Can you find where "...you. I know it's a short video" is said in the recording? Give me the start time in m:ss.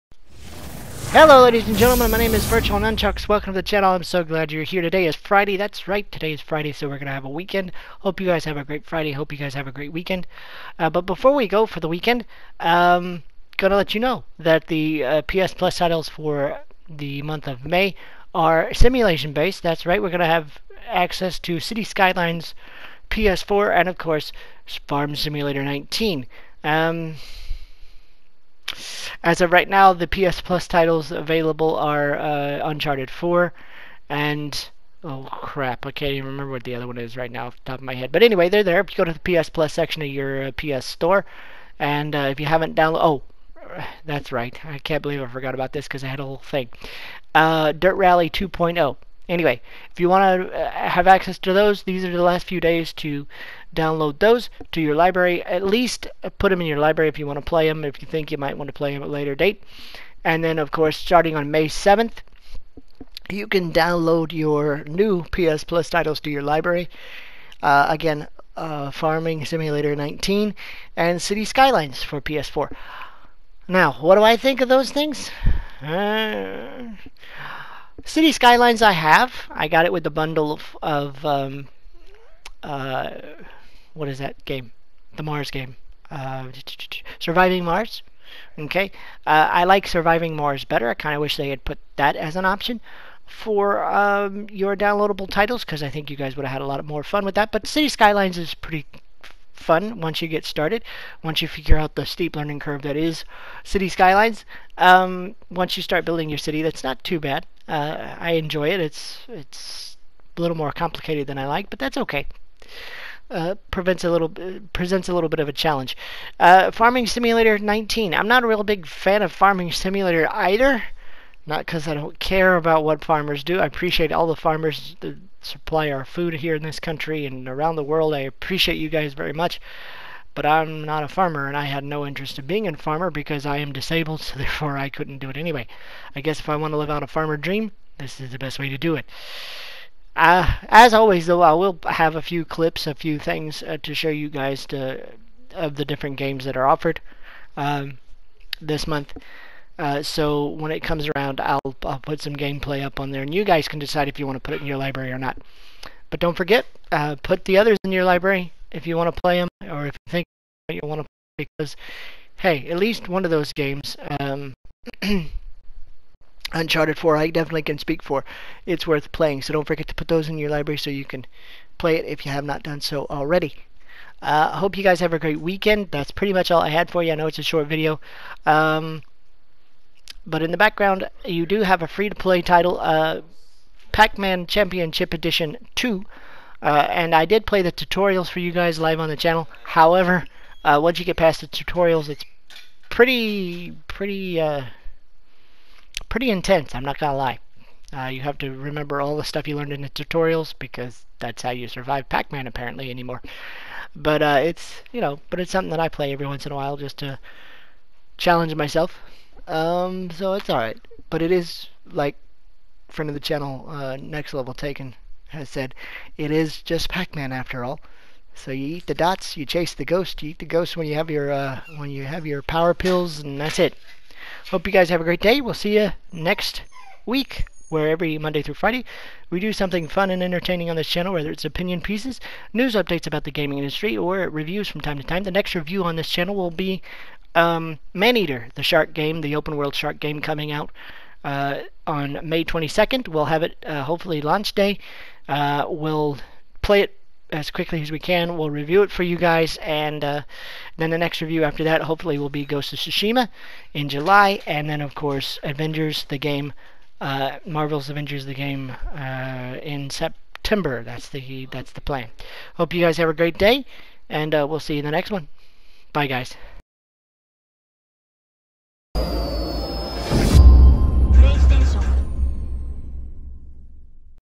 2:57.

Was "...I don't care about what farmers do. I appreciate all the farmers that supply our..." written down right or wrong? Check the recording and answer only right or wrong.
right.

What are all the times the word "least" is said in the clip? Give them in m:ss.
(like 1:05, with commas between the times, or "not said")
0:55, 2:42.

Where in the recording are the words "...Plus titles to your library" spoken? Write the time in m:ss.
1:05.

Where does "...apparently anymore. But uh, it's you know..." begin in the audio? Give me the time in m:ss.
3:22.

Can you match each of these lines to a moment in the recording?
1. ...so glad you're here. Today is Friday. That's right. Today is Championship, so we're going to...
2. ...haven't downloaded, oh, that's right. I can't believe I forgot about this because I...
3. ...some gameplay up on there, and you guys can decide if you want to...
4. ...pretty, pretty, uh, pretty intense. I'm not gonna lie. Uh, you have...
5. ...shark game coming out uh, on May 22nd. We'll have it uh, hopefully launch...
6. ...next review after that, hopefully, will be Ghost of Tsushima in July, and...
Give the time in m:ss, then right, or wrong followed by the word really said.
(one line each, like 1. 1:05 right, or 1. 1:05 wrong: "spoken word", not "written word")
1. 0:04 wrong: "Friday", not "Championship"
2. 0:42 right
3. 2:32 right
4. 3:12 right
5. 3:59 right
6. 4:10 right.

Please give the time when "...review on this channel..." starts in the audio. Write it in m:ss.
3:55.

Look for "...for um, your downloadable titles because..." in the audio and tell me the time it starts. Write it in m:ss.
1:33.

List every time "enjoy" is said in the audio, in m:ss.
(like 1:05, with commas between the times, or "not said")
1:48.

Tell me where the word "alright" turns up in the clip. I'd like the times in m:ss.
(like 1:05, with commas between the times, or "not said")
3:30.